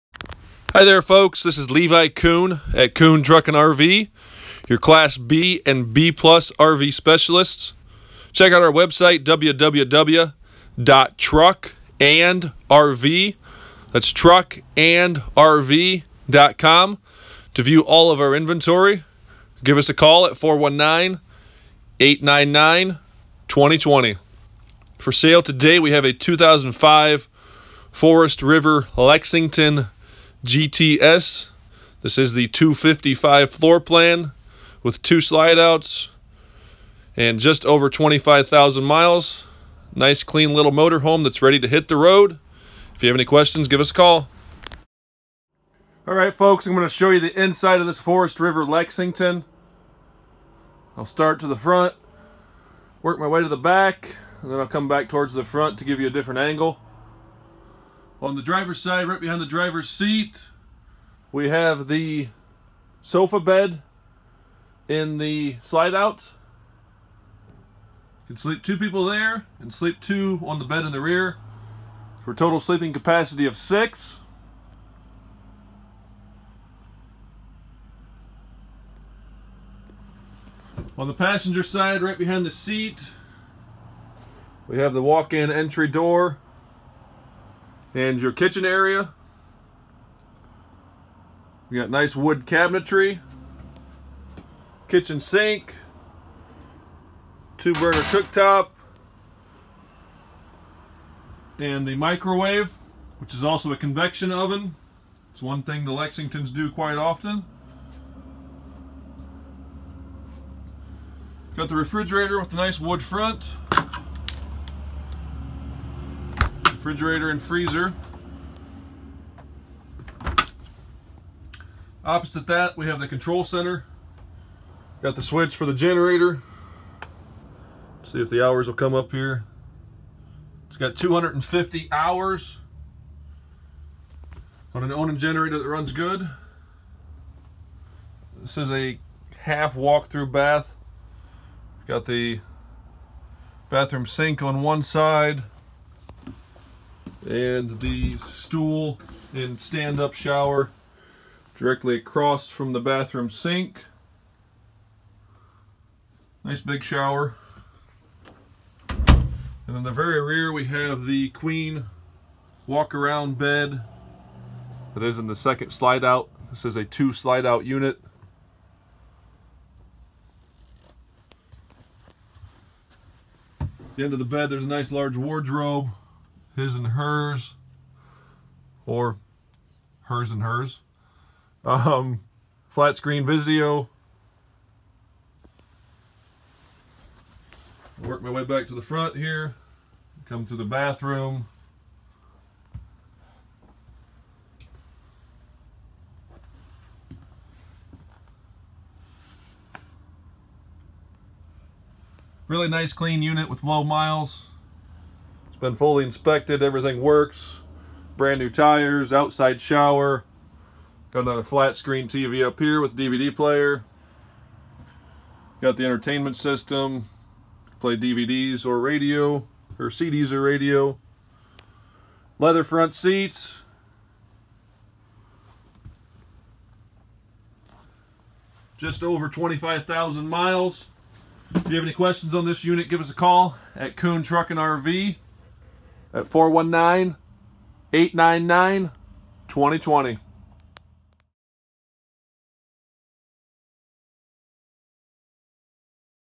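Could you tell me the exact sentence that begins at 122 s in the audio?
Opposite that, we have the control center.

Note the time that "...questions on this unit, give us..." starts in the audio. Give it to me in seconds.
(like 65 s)
231 s.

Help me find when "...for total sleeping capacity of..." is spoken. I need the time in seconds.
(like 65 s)
72 s.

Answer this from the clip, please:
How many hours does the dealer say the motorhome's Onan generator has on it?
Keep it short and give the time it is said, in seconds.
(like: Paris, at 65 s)
250, at 130 s.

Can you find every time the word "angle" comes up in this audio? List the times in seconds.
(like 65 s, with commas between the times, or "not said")
56 s.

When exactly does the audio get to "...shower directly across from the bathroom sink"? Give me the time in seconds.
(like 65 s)
150 s.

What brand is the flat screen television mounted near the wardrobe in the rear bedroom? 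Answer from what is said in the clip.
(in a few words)
Vizio.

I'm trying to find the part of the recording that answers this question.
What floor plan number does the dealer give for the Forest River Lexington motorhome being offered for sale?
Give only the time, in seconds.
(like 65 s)
32 s.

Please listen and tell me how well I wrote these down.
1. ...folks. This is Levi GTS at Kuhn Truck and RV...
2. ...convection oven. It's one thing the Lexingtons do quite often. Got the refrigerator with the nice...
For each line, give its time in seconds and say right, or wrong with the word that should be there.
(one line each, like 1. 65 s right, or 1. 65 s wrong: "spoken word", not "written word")
1. 1 s wrong: "Kuhn", not "GTS"
2. 103 s right.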